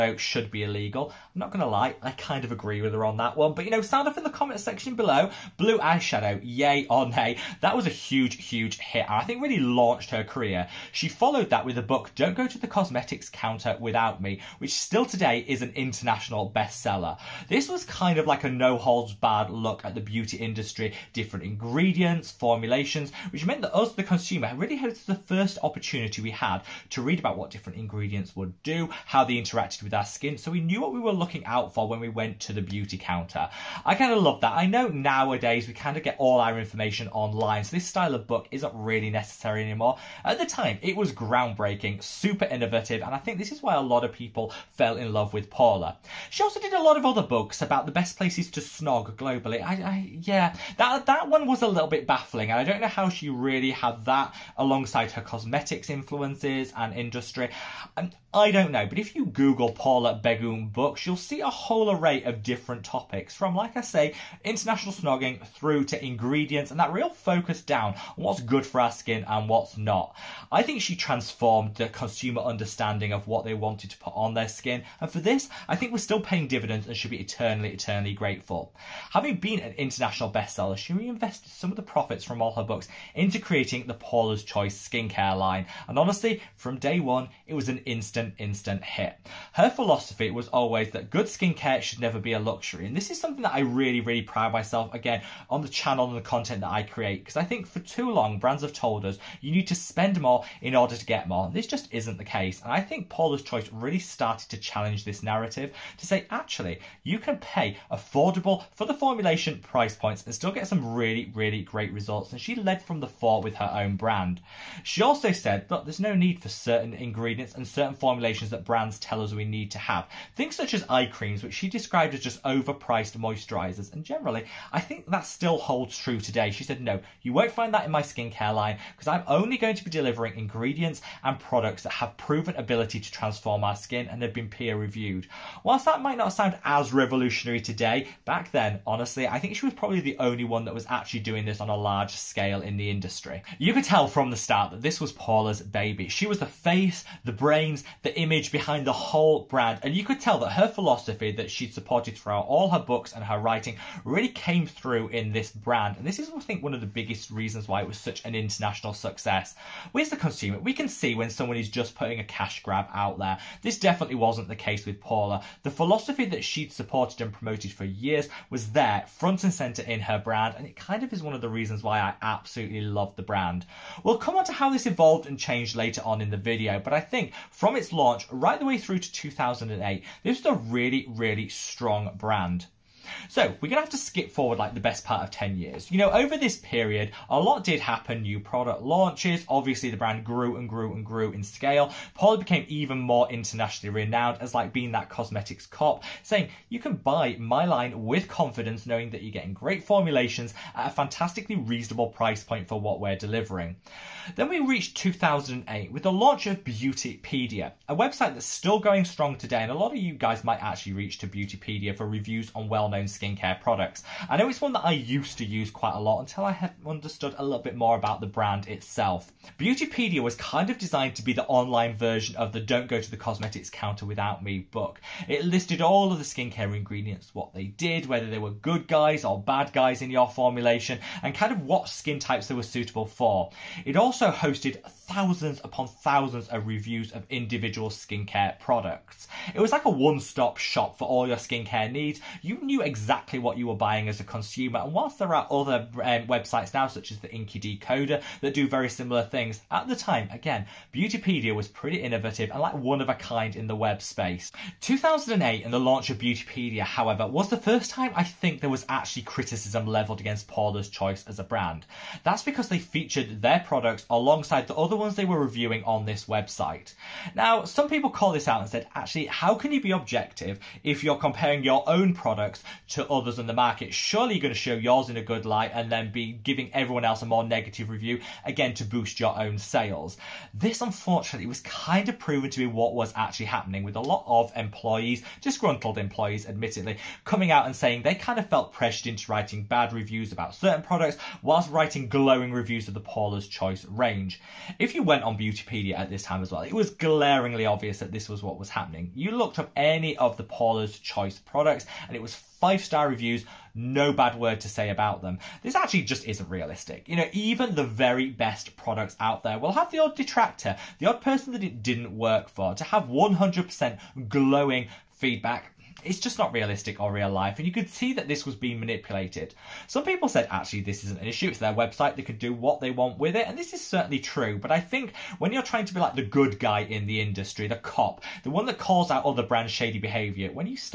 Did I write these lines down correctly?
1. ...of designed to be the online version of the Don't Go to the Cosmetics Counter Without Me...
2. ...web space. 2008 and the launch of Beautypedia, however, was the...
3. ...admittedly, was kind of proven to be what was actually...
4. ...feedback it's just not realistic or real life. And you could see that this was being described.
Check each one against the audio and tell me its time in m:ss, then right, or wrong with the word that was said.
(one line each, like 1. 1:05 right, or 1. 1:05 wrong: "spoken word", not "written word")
1. 3:40 right
2. 4:13 right
3. 4:40 wrong: "unfortunately", not "admittedly"
4. 5:15 wrong: "manipulated", not "described".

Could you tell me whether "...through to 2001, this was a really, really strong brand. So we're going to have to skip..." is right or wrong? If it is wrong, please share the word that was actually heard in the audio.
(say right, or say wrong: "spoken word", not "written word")
wrong: "2008", not "2001".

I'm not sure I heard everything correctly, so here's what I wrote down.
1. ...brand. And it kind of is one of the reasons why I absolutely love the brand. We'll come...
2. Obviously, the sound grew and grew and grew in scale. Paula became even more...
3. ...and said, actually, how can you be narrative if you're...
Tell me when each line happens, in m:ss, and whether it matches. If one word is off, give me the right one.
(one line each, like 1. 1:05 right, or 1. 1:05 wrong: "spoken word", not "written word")
1. 2:50 right
2. 3:09 wrong: "brand", not "sound"
3. 4:28 wrong: "objective", not "narrative".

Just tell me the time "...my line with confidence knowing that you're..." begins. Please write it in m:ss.
3:17.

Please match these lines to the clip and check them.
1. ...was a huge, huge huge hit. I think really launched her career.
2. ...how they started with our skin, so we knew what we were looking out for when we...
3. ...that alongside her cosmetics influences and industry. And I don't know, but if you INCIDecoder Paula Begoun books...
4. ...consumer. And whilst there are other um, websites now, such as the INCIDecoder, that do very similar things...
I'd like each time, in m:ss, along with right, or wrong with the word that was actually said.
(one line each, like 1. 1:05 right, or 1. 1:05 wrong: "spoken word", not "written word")
1. 0:07 right
2. 0:29 wrong: "interacted", not "started"
3. 0:54 wrong: "Google", not "INCIDecoder"
4. 4:04 right.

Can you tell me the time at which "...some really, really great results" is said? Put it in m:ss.
1:50.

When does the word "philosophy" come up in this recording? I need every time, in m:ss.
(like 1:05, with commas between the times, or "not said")
1:29, 2:30, 2:45.